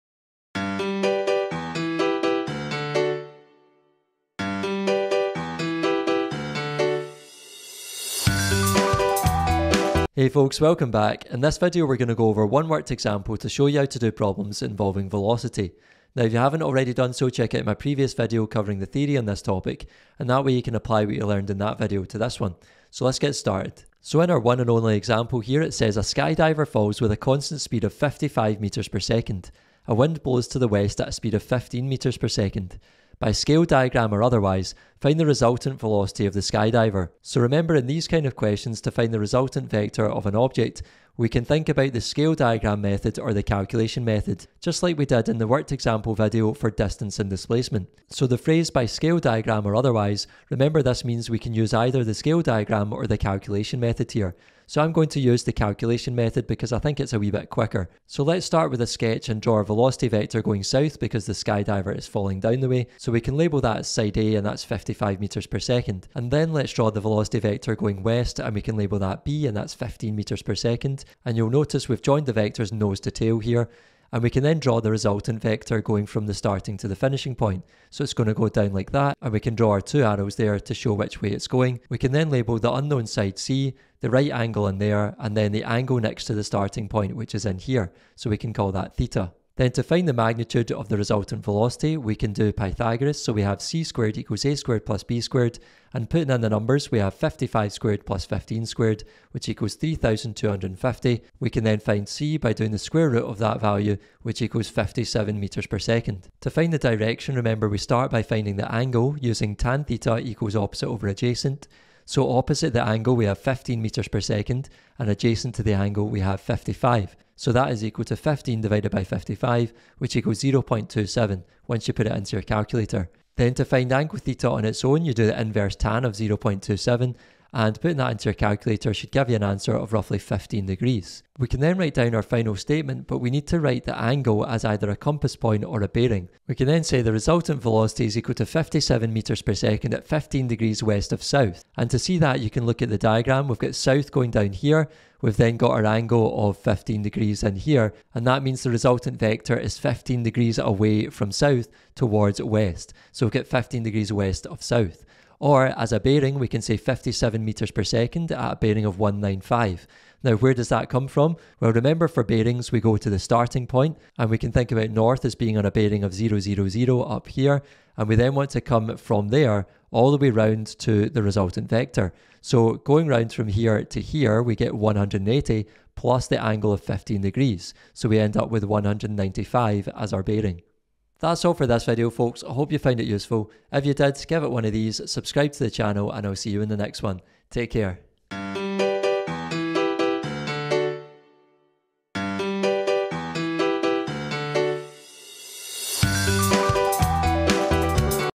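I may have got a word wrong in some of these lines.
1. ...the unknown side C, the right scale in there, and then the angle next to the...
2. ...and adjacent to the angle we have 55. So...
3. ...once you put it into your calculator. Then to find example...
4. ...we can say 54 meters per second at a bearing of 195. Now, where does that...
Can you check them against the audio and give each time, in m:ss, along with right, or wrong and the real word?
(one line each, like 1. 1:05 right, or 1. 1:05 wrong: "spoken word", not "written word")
1. 1:22 wrong: "angle", not "scale"
2. 1:54 right
3. 2:01 wrong: "angle", not "example"
4. 2:36 wrong: "57", not "54".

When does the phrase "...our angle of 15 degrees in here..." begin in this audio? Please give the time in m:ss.
2:25.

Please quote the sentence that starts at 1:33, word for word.
So we have c squared equals a squared plus b squared.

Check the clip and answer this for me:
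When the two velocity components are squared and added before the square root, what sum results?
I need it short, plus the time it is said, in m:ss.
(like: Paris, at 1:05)
3,250, at 1:39.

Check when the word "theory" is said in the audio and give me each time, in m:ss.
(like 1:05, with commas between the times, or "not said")
0:18.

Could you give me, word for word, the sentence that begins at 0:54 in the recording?
So I'm going to use the calculation method because I think it's a wee bit quicker.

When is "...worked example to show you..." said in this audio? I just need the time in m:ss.
0:12.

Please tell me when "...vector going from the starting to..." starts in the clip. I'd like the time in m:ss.
1:15.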